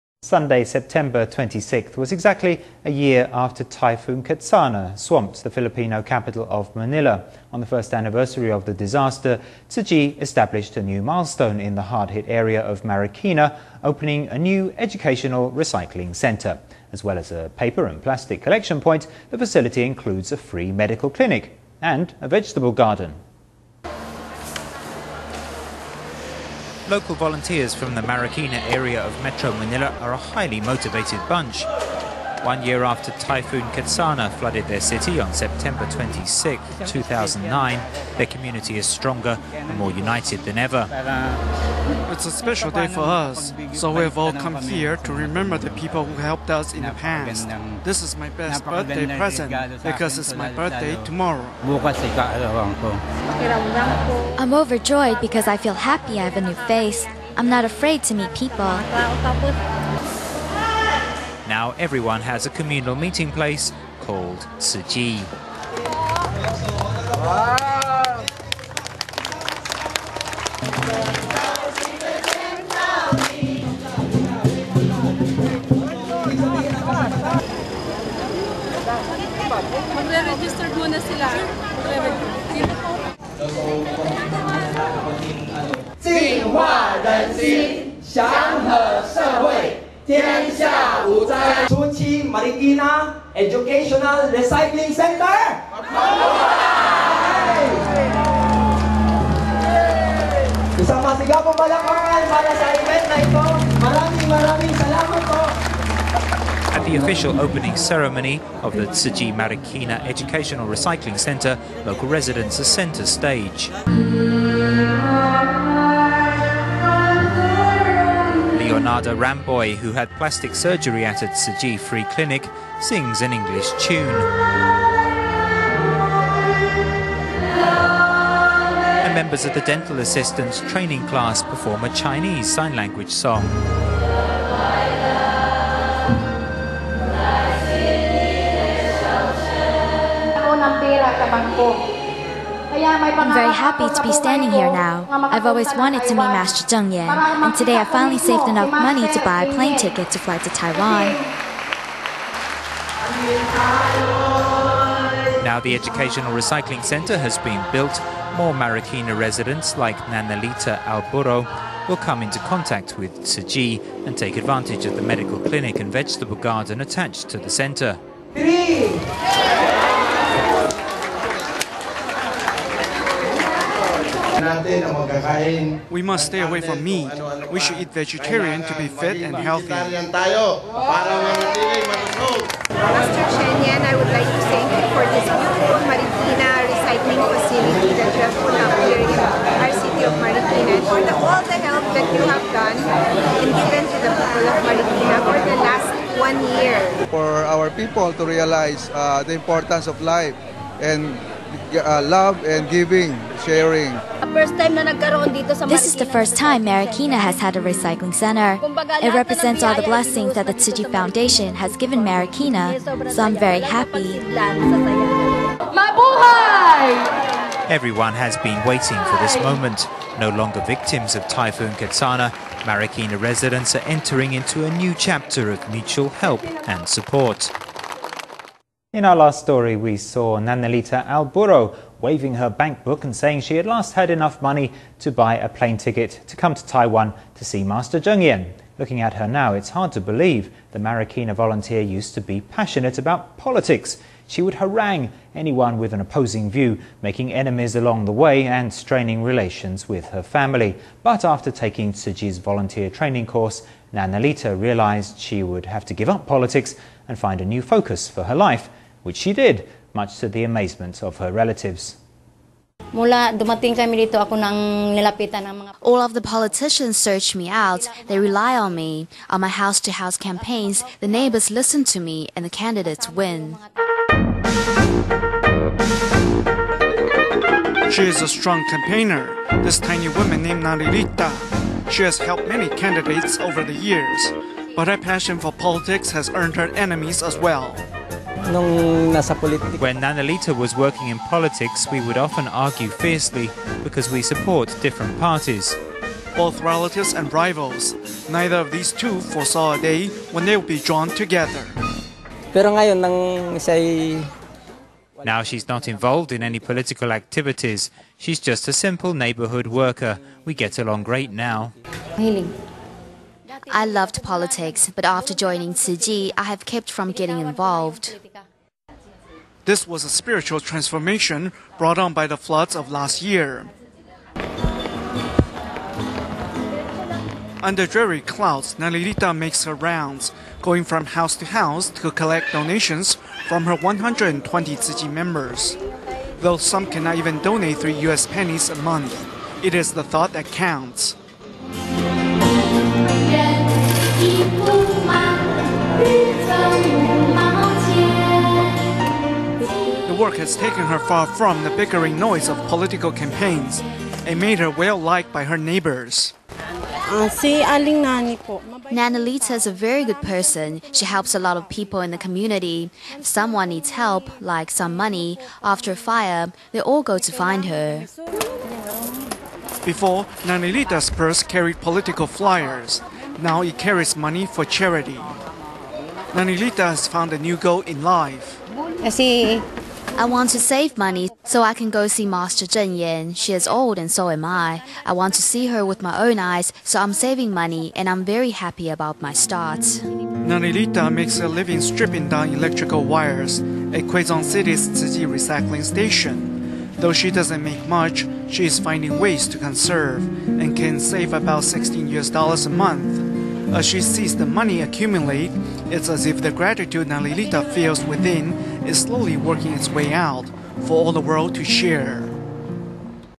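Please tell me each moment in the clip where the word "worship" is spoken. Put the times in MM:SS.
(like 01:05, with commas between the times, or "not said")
not said.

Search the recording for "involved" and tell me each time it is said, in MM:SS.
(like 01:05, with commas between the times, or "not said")
05:05, 05:17.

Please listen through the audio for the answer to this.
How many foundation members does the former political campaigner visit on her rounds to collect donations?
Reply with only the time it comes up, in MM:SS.
05:33.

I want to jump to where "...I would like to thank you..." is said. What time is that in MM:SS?
03:03.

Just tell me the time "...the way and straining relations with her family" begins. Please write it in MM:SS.
04:08.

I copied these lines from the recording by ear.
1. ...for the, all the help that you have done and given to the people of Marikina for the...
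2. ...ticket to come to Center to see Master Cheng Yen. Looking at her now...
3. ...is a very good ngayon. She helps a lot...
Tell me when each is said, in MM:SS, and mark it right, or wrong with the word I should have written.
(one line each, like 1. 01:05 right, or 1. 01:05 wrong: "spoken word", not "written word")
1. 03:10 right
2. 03:55 wrong: "Taiwan", not "Center"
3. 05:59 wrong: "person", not "ngayon".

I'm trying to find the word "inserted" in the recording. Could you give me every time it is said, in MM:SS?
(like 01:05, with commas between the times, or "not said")
not said.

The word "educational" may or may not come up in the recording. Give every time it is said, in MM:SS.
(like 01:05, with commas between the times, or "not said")
00:14, 01:33, 01:50, 02:35.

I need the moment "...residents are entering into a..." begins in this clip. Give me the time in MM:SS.
03:43.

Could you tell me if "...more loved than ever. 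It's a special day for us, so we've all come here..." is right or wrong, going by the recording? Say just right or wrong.
wrong.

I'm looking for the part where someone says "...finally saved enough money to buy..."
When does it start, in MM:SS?
02:27.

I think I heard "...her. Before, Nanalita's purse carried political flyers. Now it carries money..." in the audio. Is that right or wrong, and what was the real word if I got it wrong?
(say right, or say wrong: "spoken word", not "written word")
right.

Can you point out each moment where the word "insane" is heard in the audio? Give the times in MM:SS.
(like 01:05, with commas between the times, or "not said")
not said.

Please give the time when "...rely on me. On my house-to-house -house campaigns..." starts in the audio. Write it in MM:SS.
04:28.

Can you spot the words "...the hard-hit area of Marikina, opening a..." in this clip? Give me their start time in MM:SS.
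00:11.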